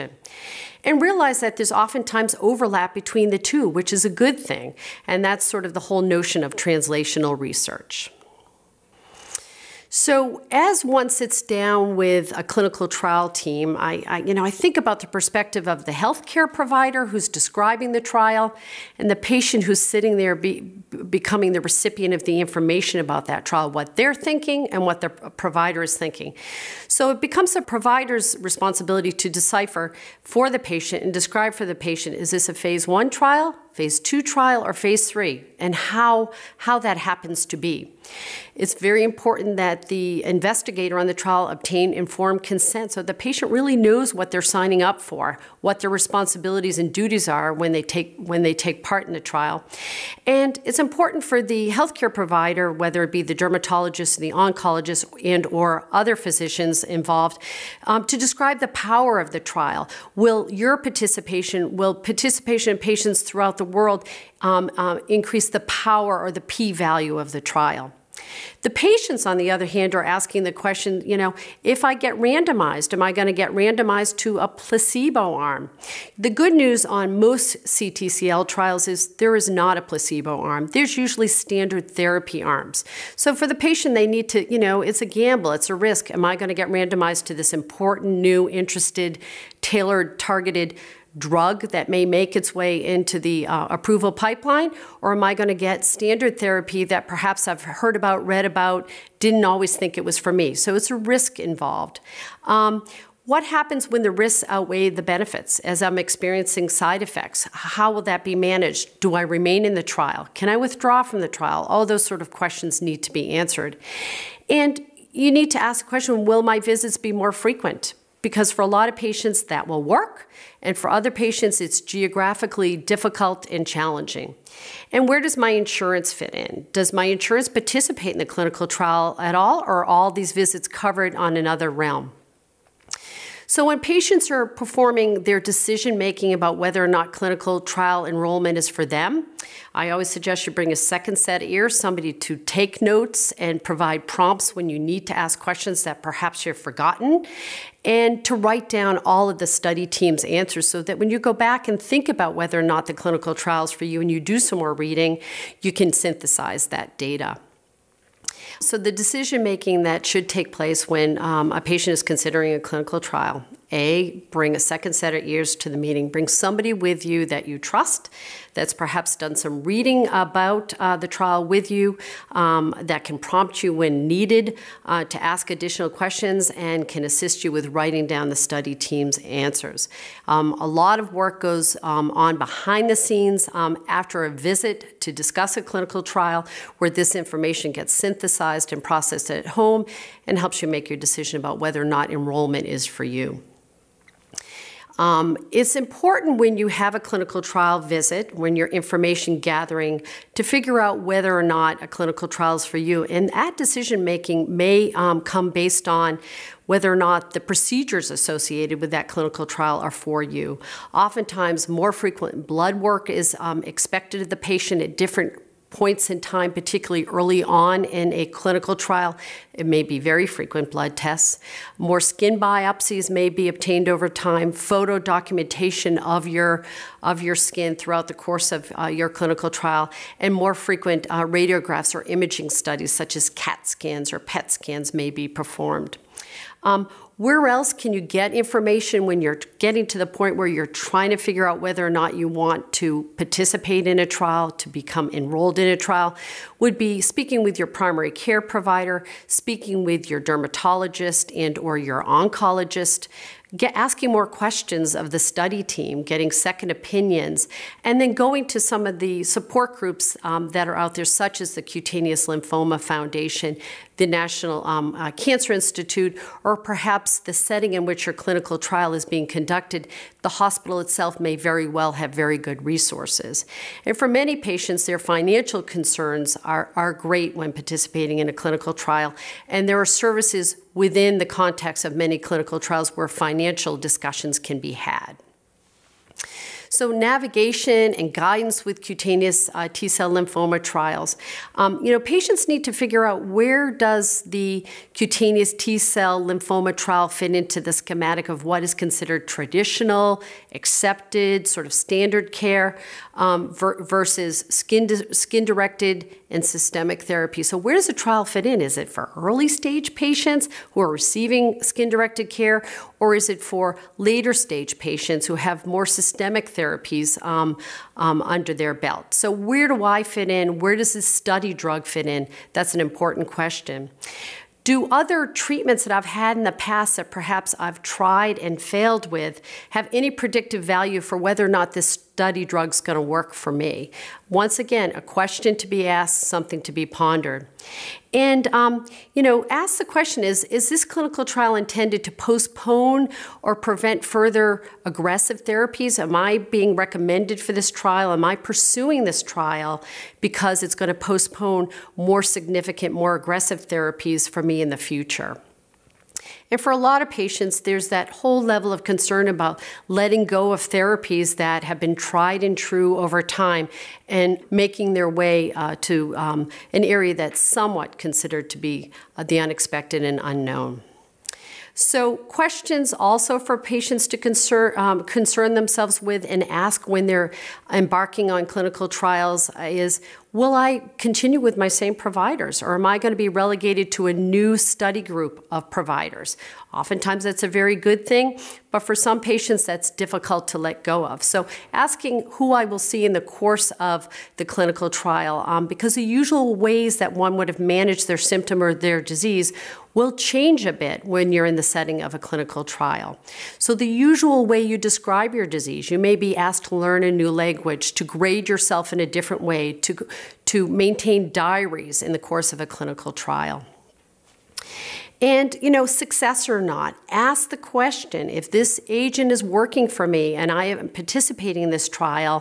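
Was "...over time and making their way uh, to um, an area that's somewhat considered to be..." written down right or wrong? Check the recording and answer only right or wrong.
right.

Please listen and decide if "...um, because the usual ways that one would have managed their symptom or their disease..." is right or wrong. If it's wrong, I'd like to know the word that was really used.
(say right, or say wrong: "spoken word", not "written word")
right.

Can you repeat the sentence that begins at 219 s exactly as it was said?
It may be very frequent blood tests.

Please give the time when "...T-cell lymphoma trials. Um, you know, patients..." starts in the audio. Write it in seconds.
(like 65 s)
289 s.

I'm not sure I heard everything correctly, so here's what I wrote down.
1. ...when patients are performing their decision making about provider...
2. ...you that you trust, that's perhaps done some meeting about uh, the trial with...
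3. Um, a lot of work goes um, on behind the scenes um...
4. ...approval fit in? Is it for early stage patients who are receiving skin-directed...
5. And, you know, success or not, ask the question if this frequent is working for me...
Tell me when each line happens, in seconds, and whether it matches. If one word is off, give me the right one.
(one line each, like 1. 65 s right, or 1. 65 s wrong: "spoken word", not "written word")
1. 133 s wrong: "whether", not "provider"
2. 167 s wrong: "reading", not "meeting"
3. 180 s right
4. 307 s wrong: "trial", not "approval"
5. 415 s wrong: "agent", not "frequent".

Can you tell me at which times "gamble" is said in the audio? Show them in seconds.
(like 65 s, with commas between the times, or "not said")
85 s.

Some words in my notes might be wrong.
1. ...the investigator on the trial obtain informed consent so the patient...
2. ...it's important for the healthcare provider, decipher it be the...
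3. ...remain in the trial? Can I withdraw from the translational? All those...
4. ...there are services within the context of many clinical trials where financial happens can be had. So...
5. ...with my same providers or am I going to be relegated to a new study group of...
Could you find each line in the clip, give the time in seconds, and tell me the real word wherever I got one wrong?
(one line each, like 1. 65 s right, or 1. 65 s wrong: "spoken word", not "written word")
1. 39 s right
2. 50 s wrong: "whether", not "decipher"
3. 109 s wrong: "trial", not "translational"
4. 279 s wrong: "discussions", not "happens"
5. 381 s right.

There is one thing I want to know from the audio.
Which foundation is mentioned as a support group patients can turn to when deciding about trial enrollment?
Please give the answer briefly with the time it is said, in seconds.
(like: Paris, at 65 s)
Cutaneous Lymphoma Foundation, at 261 s.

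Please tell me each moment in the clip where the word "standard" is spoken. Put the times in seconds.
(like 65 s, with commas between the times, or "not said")
81 s, 95 s, 301 s.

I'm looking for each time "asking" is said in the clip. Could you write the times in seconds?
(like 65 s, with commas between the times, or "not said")
70 s, 253 s, 391 s.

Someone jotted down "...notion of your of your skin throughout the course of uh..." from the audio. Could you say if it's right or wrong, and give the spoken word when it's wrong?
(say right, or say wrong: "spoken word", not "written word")
wrong: "documentation", not "notion".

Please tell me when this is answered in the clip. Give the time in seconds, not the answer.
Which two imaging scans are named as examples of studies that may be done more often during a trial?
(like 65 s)
233 s.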